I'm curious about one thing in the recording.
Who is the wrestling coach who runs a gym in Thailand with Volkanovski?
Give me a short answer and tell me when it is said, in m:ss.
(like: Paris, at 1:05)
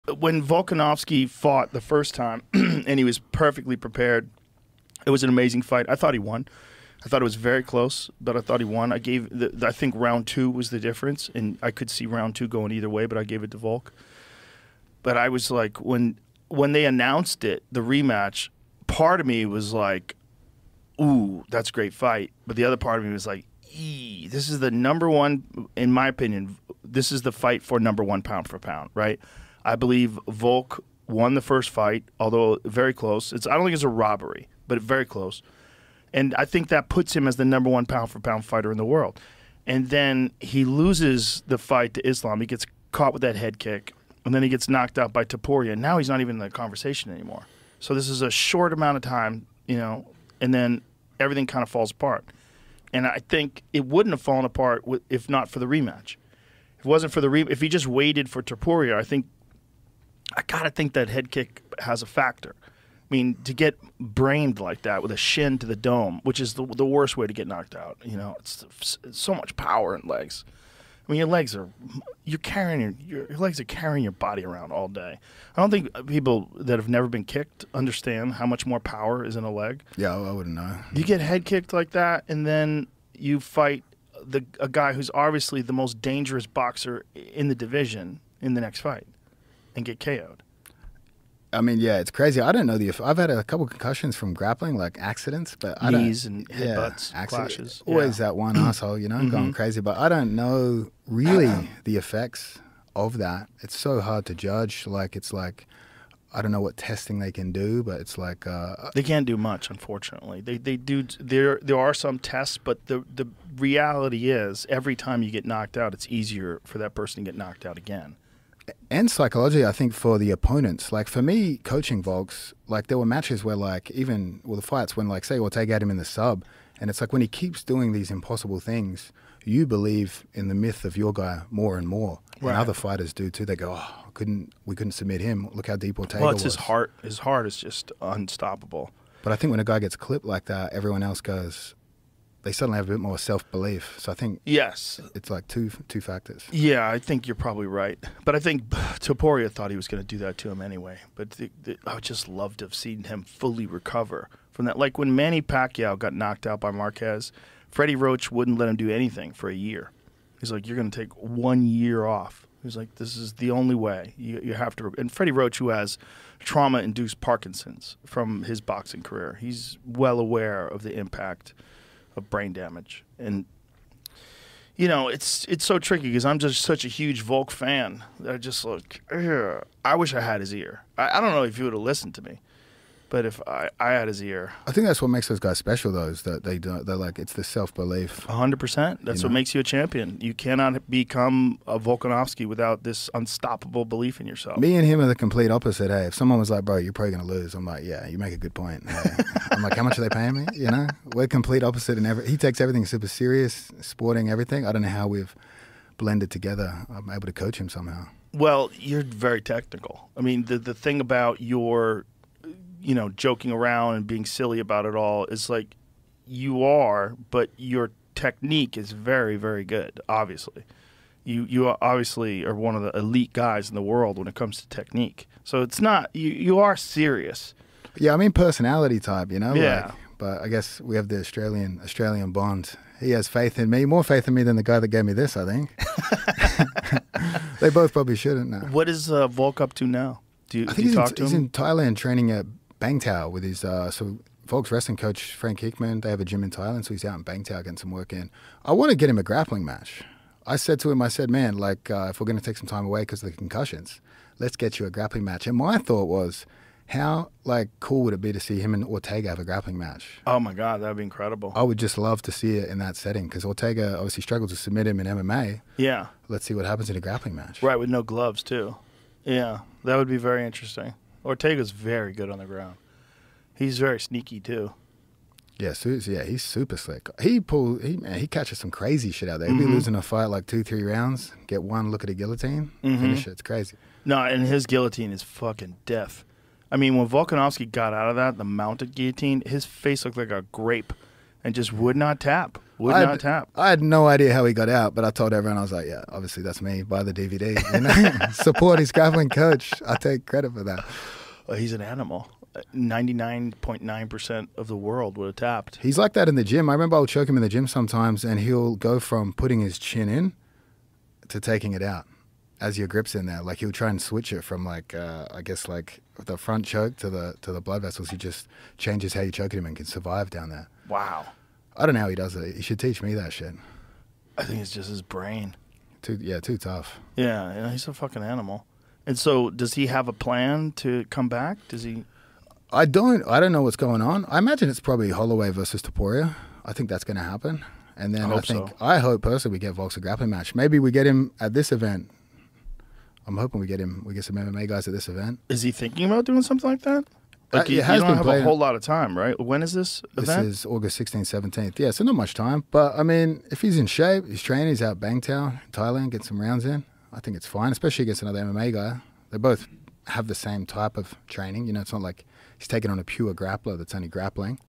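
Frank Hickman, at 4:05.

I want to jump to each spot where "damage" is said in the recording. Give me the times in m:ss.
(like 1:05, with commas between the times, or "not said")
2:52.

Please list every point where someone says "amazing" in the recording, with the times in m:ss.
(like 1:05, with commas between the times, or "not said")
0:05.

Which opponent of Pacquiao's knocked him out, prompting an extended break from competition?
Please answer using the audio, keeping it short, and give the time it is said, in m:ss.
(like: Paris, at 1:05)
Marquez, at 2:36.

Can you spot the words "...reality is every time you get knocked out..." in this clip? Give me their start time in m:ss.
1:53.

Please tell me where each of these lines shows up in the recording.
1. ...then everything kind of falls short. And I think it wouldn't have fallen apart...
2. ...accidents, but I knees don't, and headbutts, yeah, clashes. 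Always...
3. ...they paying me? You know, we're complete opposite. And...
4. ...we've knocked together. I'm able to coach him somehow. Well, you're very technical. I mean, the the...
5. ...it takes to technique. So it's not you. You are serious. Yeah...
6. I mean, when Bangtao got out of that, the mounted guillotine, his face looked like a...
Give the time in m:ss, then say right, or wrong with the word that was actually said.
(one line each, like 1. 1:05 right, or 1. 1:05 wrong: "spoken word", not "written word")
1. 0:50 wrong: "apart", not "short"
2. 1:34 right
3. 3:20 right
4. 3:25 wrong: "blended", not "knocked"
5. 3:44 wrong: "comes", not "takes"
6. 4:46 wrong: "Volkanovski", not "Bangtao".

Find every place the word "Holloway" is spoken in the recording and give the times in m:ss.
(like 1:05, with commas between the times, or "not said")
5:35.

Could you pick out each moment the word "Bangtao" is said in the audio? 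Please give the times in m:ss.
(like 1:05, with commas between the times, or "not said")
4:02, 4:07, 5:54.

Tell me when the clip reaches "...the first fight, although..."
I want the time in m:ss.
0:31.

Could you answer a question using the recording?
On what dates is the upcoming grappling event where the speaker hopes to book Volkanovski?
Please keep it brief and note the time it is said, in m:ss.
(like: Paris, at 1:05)
August 16th, 17th, at 5:50.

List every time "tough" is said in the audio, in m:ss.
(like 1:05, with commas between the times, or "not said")
5:26.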